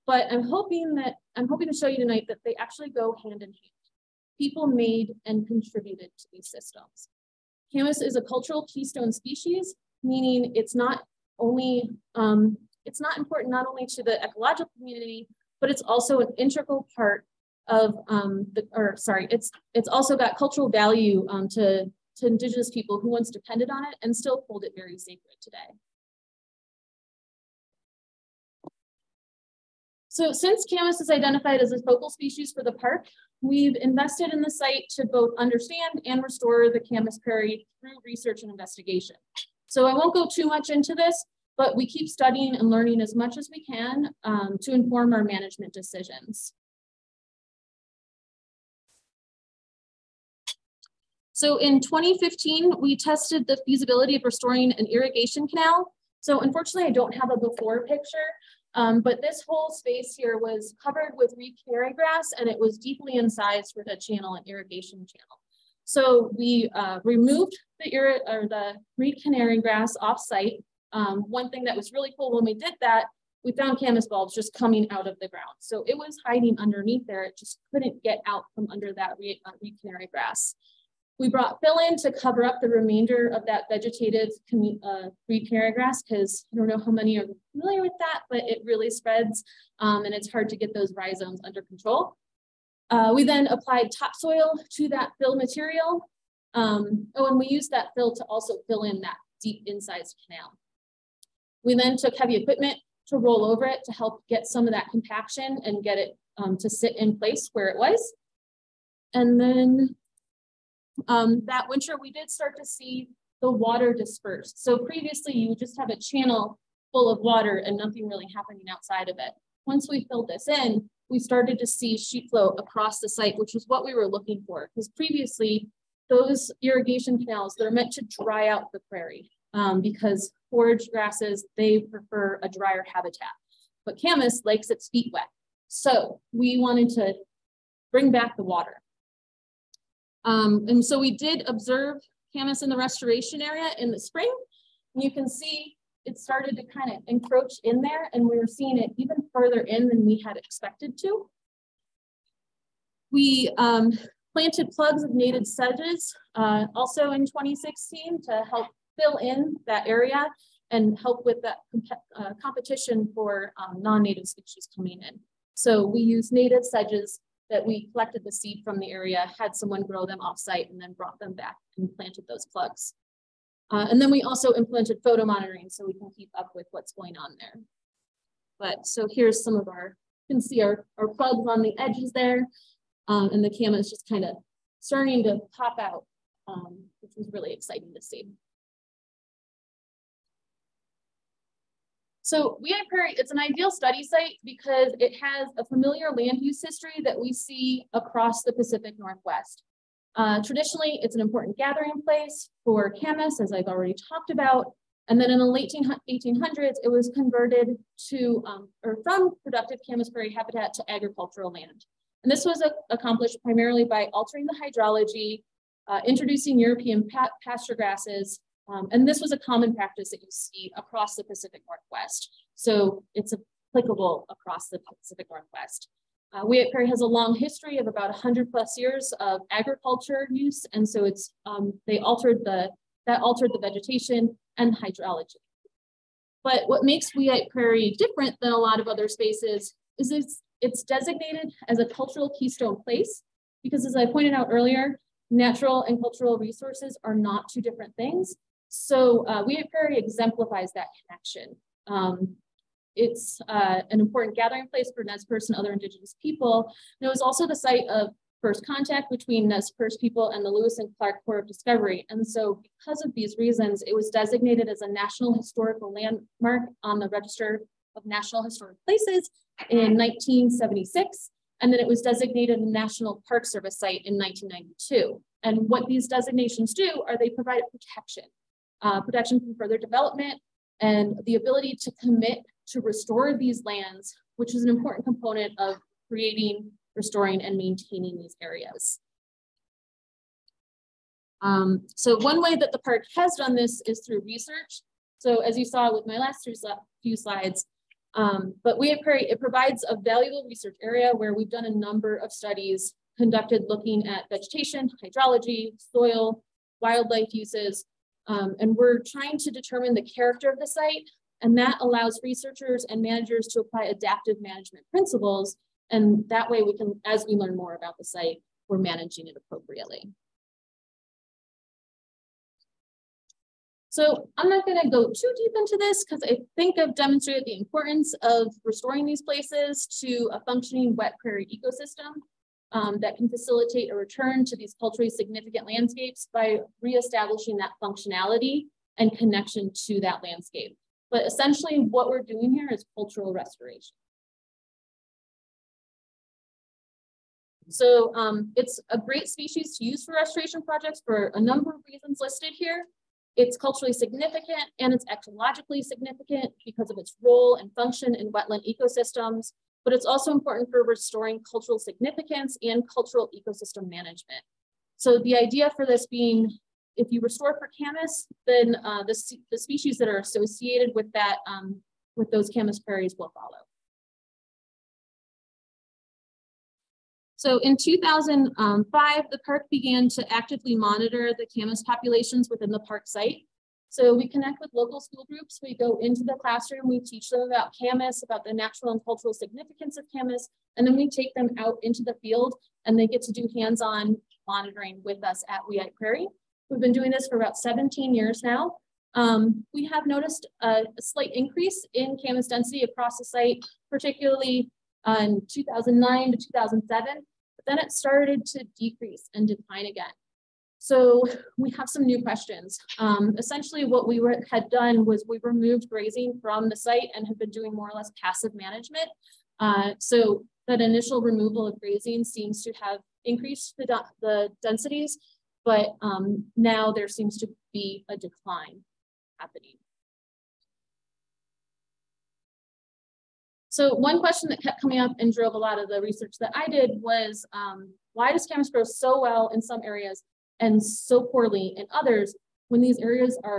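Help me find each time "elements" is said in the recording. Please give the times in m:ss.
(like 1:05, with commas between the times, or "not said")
not said.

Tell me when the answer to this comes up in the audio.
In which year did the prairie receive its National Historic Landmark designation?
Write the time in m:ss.
4:29.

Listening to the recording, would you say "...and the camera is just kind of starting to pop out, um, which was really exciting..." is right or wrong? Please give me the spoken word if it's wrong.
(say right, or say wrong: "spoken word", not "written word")
right.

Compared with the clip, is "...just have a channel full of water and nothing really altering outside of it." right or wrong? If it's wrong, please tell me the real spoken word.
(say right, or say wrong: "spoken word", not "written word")
wrong: "happening", not "altering".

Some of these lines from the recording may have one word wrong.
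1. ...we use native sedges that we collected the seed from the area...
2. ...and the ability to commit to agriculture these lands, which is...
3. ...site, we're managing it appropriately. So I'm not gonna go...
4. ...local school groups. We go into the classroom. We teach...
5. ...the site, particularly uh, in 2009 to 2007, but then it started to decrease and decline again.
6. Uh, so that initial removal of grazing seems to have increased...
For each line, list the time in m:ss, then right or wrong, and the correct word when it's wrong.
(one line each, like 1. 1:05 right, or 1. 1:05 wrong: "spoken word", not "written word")
1. 2:45 right
2. 4:40 wrong: "restore", not "agriculture"
3. 5:18 right
4. 6:24 right
5. 6:43 right
6. 6:59 right.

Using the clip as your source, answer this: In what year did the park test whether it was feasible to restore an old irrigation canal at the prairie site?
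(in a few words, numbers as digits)
2015.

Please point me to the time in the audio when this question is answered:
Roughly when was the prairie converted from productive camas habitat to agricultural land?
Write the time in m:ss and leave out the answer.
3:25.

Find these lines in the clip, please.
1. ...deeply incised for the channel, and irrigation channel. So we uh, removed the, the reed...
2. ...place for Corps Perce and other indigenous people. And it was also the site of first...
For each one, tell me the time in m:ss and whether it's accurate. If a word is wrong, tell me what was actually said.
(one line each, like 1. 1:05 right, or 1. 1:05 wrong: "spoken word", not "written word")
1. 1:02 right
2. 4:14 wrong: "Nez", not "Corps".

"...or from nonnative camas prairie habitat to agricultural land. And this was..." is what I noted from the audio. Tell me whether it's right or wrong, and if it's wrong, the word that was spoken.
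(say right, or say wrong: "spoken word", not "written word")
wrong: "productive", not "nonnative".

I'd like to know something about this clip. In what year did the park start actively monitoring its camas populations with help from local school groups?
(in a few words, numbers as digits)
2005.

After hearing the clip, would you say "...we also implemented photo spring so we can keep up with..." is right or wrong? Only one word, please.
wrong.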